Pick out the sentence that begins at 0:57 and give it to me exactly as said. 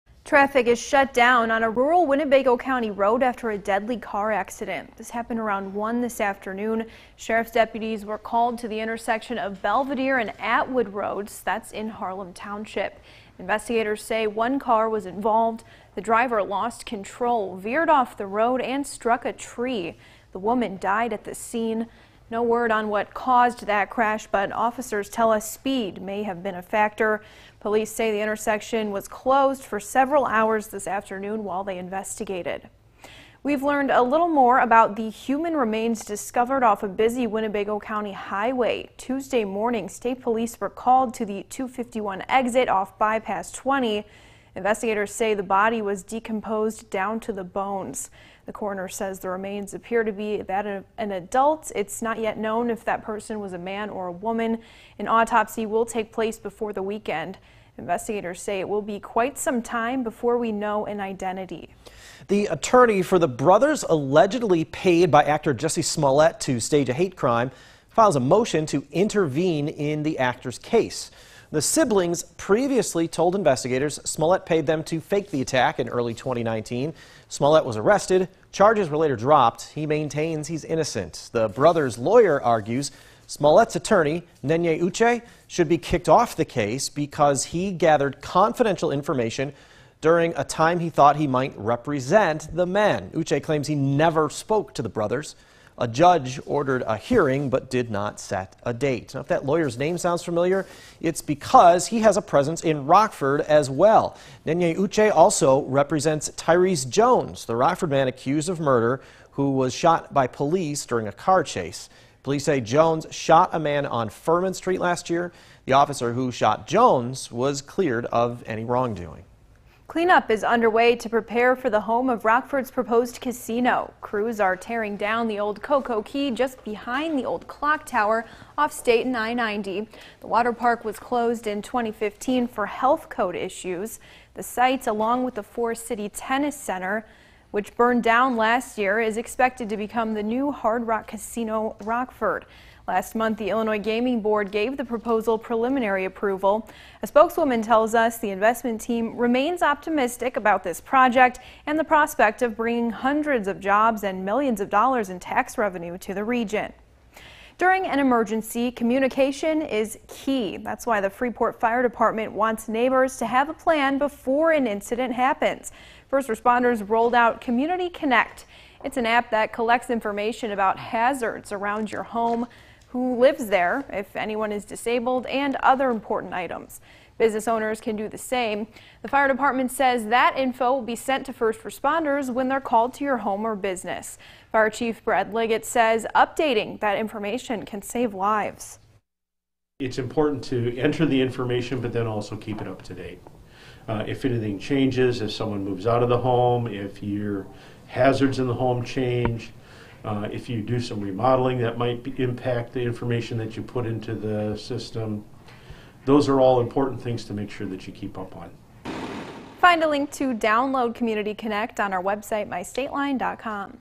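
Investigators say it will be quite some time before we know an identity.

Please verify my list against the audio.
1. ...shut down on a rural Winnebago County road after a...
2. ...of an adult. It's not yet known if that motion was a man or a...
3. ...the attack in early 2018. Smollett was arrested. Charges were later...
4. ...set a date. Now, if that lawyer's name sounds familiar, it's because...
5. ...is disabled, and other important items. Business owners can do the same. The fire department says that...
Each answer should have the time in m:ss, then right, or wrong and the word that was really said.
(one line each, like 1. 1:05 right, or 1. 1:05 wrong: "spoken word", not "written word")
1. 0:00 right
2. 0:50 wrong: "person", not "motion"
3. 1:15 wrong: "2019", not "2018"
4. 1:38 right
5. 2:54 right.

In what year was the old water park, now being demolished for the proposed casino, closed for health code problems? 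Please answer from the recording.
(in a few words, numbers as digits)
2015.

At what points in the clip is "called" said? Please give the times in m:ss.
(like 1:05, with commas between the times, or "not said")
0:08, 0:40, 3:02.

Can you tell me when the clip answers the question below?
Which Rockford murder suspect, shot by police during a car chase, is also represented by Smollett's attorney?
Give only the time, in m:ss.
1:46.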